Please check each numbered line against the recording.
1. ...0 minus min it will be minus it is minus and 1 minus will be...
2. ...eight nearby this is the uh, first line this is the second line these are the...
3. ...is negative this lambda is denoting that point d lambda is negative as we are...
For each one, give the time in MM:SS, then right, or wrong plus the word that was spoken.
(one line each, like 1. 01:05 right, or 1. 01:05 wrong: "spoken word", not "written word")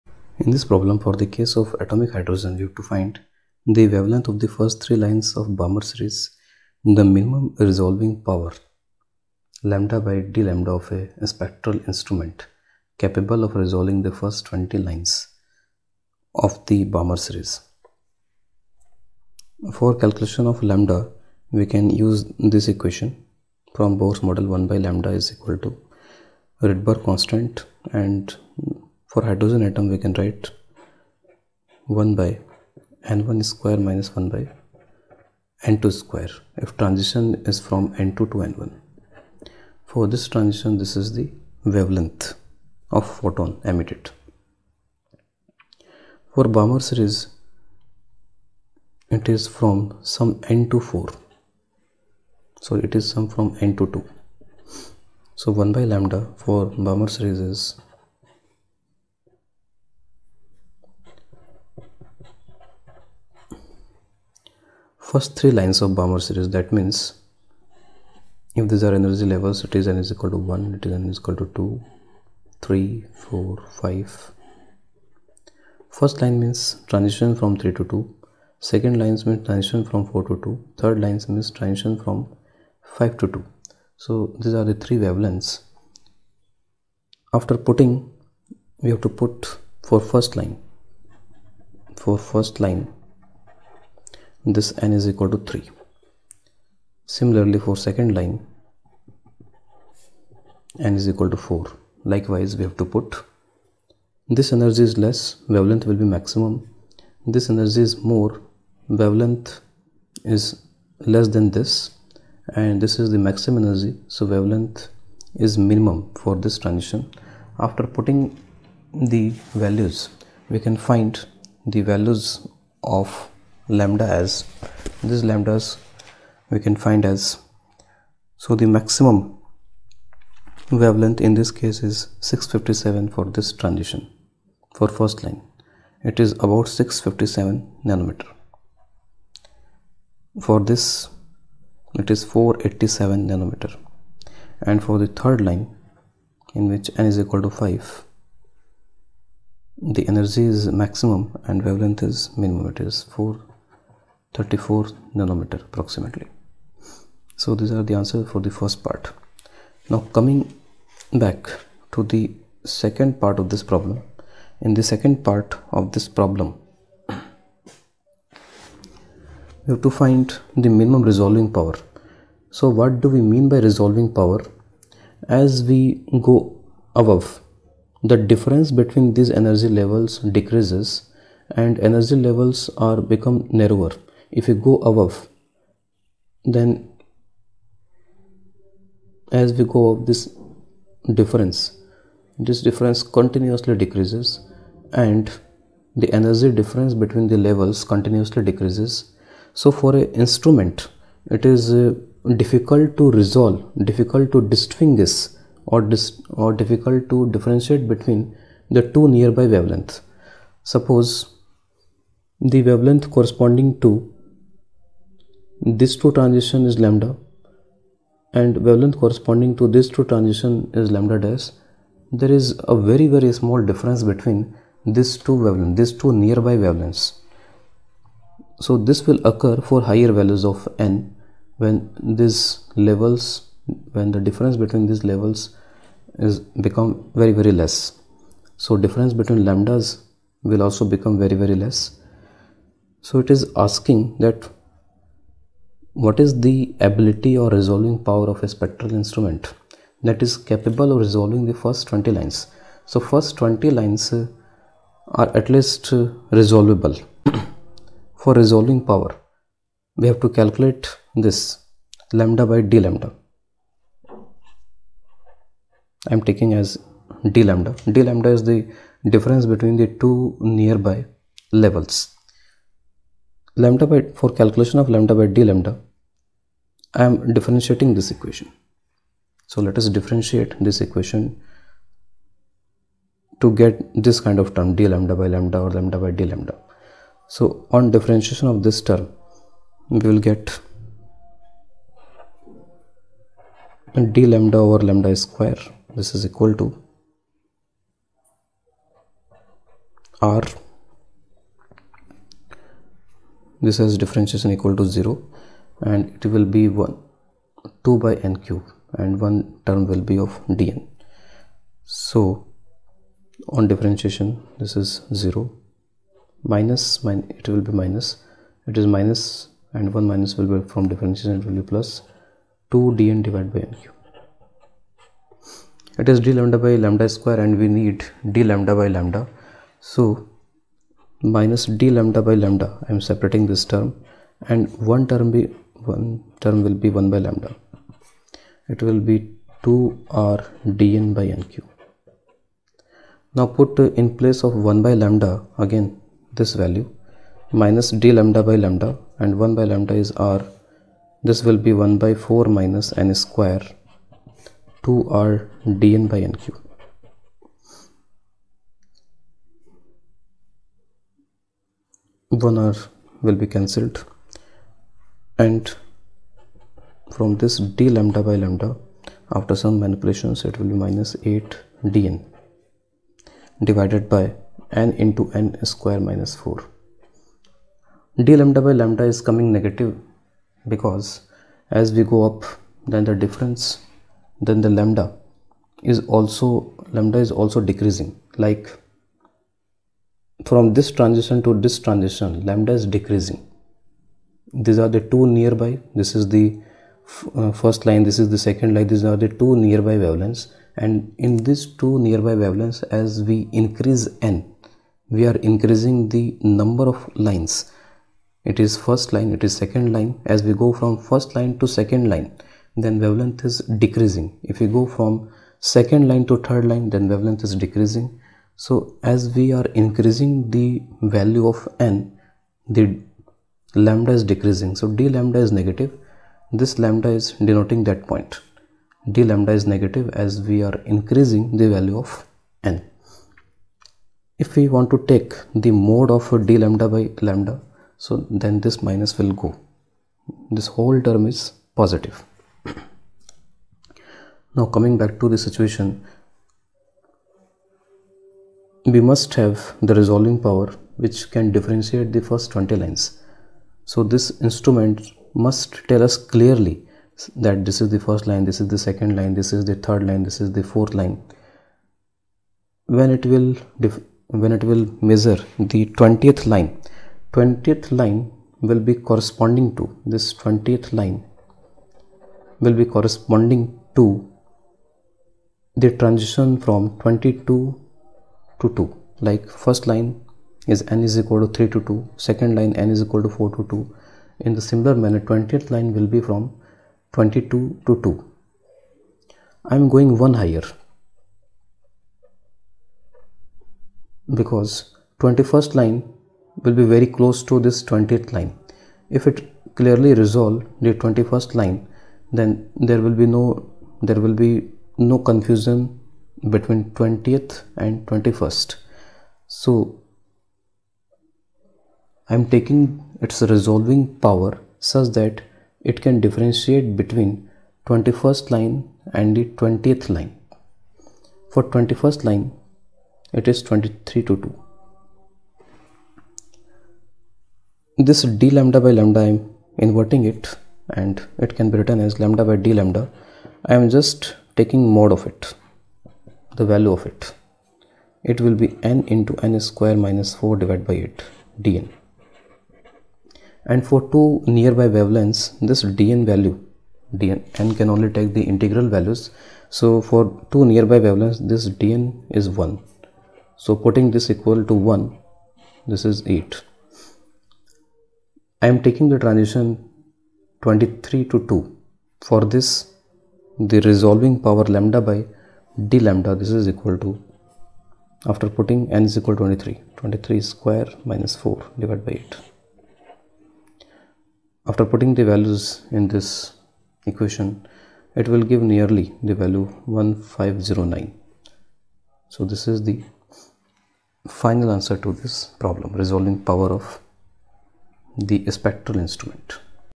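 1. 05:15 right
2. 06:35 wrong: "two", not "eight"
3. 07:05 right.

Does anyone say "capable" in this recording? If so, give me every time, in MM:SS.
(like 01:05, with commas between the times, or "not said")
00:12, 04:10.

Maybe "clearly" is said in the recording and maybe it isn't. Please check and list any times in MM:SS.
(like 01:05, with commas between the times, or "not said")
07:36, 08:19.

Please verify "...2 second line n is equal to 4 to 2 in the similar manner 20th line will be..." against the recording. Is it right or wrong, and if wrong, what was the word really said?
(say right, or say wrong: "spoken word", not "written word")
right.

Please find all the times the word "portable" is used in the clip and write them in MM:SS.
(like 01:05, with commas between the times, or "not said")
not said.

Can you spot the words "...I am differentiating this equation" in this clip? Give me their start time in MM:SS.
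04:36.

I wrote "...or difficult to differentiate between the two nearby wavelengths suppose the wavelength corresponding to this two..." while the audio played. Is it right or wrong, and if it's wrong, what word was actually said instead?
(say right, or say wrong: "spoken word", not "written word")
right.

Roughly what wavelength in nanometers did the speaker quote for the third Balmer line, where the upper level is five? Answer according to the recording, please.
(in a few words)
434 nanometers.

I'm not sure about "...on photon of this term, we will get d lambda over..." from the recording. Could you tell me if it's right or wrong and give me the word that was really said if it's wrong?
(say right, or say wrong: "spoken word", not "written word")
wrong: "differentiation", not "photon".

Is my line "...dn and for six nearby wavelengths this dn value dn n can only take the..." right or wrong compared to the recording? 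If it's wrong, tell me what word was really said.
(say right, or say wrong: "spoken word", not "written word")
wrong: "two", not "six".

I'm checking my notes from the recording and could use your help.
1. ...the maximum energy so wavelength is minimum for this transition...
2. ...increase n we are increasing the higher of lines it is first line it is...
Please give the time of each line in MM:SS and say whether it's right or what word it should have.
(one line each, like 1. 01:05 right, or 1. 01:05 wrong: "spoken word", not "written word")
1. 01:53 right
2. 06:43 wrong: "number", not "higher".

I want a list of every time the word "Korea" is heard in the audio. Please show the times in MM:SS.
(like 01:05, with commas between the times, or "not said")
not said.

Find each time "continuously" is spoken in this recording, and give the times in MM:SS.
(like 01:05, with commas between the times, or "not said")
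03:13, 03:17.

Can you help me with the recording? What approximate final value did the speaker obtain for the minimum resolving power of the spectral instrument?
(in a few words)
1509.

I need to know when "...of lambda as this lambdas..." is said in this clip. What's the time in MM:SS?
02:02.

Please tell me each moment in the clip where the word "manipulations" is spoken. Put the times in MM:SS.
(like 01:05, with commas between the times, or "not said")
06:09.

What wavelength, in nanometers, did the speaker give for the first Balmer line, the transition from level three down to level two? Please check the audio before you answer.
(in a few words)
657 nanometers.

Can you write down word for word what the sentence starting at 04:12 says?
So first 20 lines uh, are at least uh, resolvable.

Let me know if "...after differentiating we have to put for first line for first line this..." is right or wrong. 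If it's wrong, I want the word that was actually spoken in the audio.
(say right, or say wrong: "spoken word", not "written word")
wrong: "putting", not "differentiating".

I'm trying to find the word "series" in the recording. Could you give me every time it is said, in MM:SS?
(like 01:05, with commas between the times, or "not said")
00:05, 00:17, 00:46, 00:57, 01:06.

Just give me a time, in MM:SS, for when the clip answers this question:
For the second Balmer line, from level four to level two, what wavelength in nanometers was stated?
02:22.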